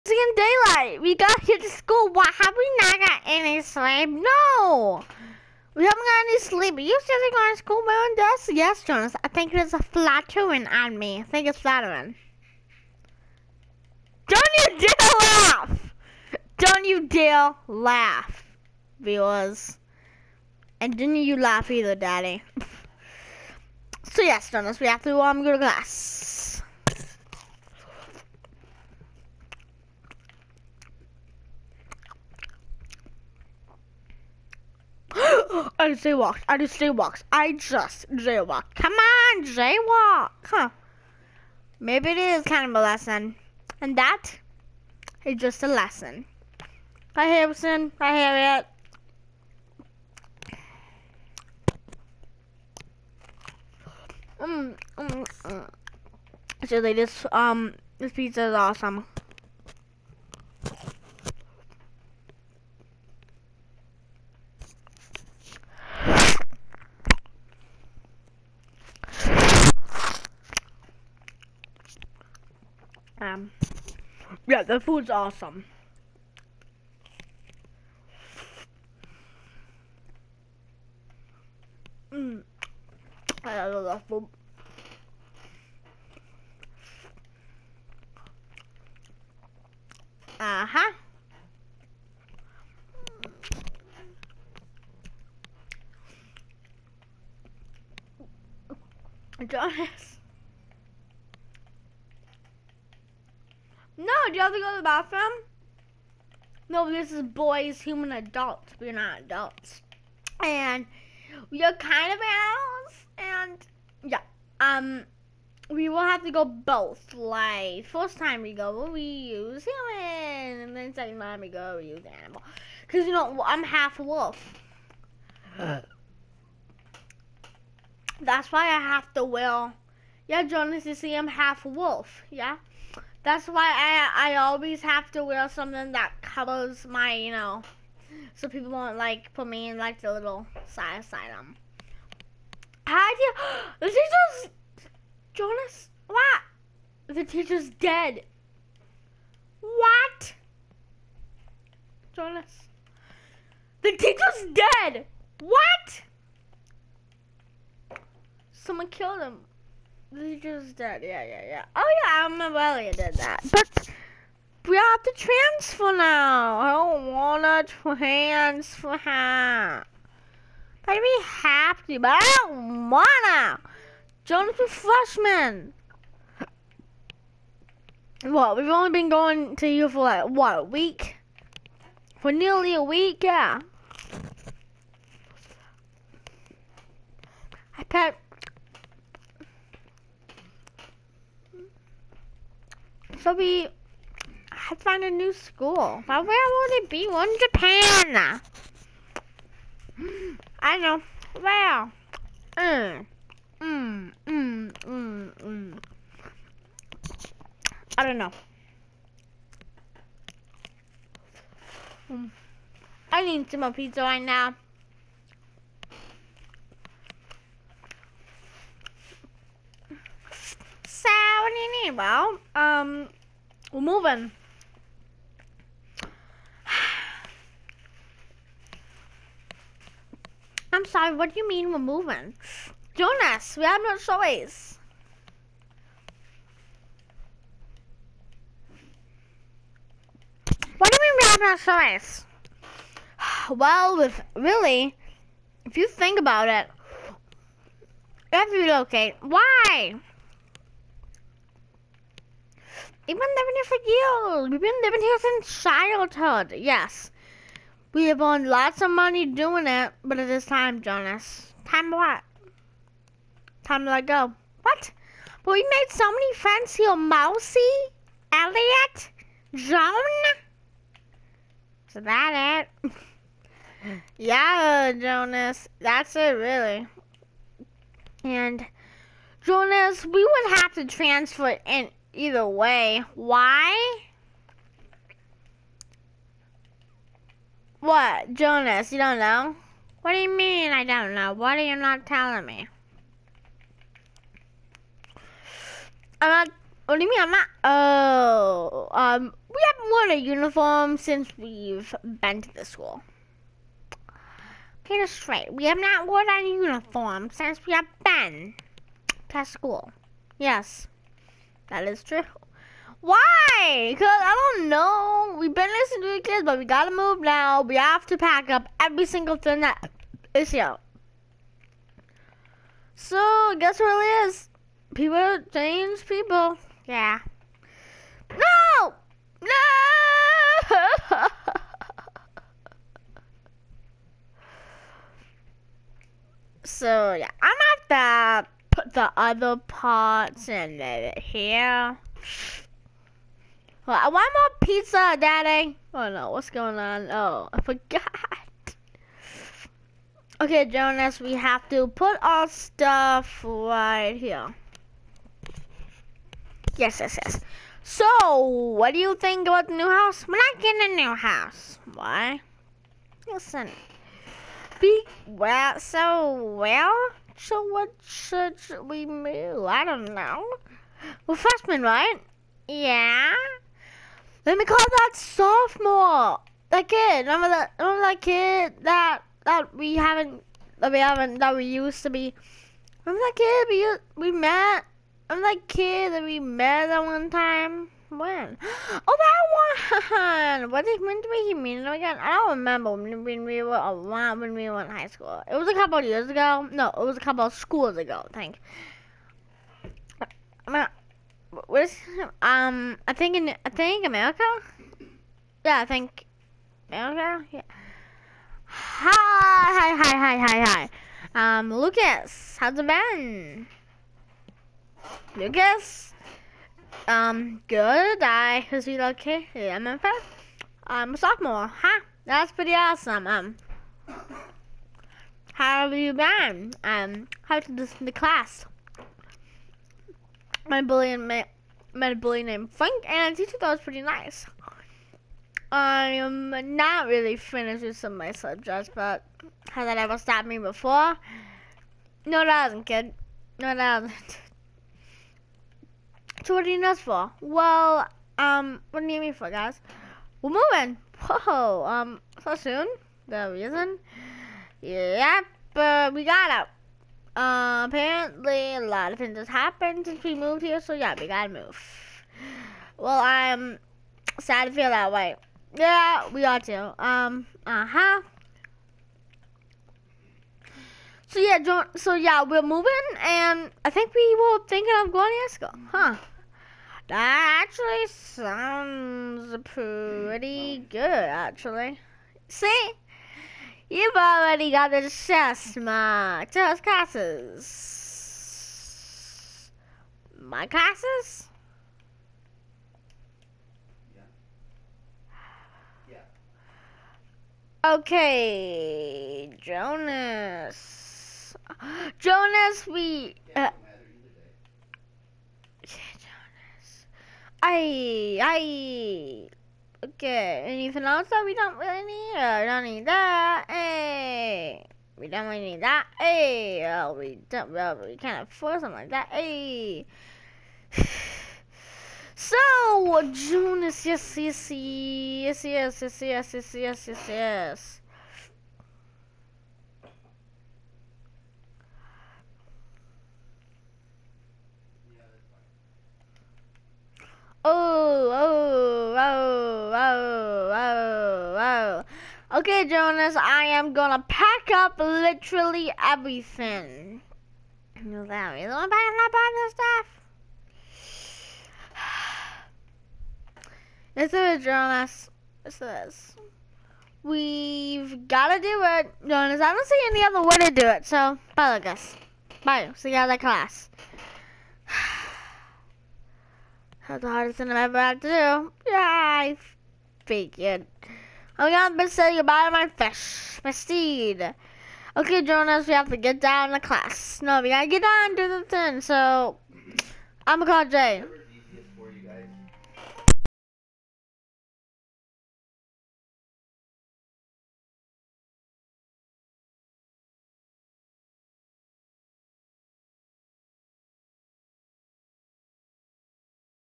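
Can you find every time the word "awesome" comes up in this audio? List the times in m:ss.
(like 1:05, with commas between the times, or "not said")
0:58, 1:15, 7:02.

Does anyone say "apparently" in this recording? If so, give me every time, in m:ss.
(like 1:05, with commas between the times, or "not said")
7:37.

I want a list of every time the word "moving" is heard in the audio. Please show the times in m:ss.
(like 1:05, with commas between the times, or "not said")
3:43, 3:51, 7:30, 7:52.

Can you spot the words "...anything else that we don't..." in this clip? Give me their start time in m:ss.
8:30.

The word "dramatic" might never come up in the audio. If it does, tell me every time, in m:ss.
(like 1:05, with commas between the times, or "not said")
not said.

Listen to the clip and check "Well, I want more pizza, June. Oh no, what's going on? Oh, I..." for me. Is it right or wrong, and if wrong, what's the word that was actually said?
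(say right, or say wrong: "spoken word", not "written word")
wrong: "Daddy", not "June".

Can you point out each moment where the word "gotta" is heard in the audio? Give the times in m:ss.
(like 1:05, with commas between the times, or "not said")
5:16, 7:41, 9:18, 9:37.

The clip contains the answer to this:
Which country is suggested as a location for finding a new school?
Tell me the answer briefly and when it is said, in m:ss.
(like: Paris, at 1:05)
Japan, at 3:17.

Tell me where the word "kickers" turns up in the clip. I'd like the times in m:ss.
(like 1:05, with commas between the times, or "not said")
not said.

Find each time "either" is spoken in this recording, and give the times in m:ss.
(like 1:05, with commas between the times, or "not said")
0:21, 4:42.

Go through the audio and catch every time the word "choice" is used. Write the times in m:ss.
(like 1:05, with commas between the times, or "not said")
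3:53, 4:01.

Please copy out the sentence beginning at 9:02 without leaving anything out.
Okay, Jonas, I am gonna pack up literally everything.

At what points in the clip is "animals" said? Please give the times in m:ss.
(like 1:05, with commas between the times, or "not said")
1:52, 2:02.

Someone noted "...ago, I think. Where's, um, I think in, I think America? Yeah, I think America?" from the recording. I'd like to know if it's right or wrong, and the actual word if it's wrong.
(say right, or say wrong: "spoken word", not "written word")
right.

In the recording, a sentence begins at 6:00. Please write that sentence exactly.
We're not getting a new house.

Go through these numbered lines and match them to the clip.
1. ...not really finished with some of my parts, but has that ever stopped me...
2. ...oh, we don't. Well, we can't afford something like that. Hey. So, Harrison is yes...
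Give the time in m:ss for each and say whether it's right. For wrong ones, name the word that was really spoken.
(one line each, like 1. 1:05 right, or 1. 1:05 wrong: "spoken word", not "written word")
1. 7:16 wrong: "subjects", not "parts"
2. 8:36 wrong: "June", not "Harrison".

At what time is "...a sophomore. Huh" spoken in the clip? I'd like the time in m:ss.
7:01.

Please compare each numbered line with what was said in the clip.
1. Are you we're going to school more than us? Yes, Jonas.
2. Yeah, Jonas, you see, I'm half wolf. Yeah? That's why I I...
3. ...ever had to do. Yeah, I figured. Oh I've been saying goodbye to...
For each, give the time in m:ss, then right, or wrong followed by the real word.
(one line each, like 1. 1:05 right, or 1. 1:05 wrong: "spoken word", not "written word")
1. 0:06 right
2. 2:10 right
3. 9:27 right.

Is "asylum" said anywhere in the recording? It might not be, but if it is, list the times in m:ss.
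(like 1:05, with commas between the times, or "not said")
2:21.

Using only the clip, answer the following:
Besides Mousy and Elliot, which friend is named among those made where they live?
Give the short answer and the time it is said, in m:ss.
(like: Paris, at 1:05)
Joan, at 4:29.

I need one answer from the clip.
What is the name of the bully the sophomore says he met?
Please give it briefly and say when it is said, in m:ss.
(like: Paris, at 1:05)
Frank, at 7:12.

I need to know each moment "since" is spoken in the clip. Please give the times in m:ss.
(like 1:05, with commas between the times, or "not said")
4:15, 5:00, 5:07, 7:40.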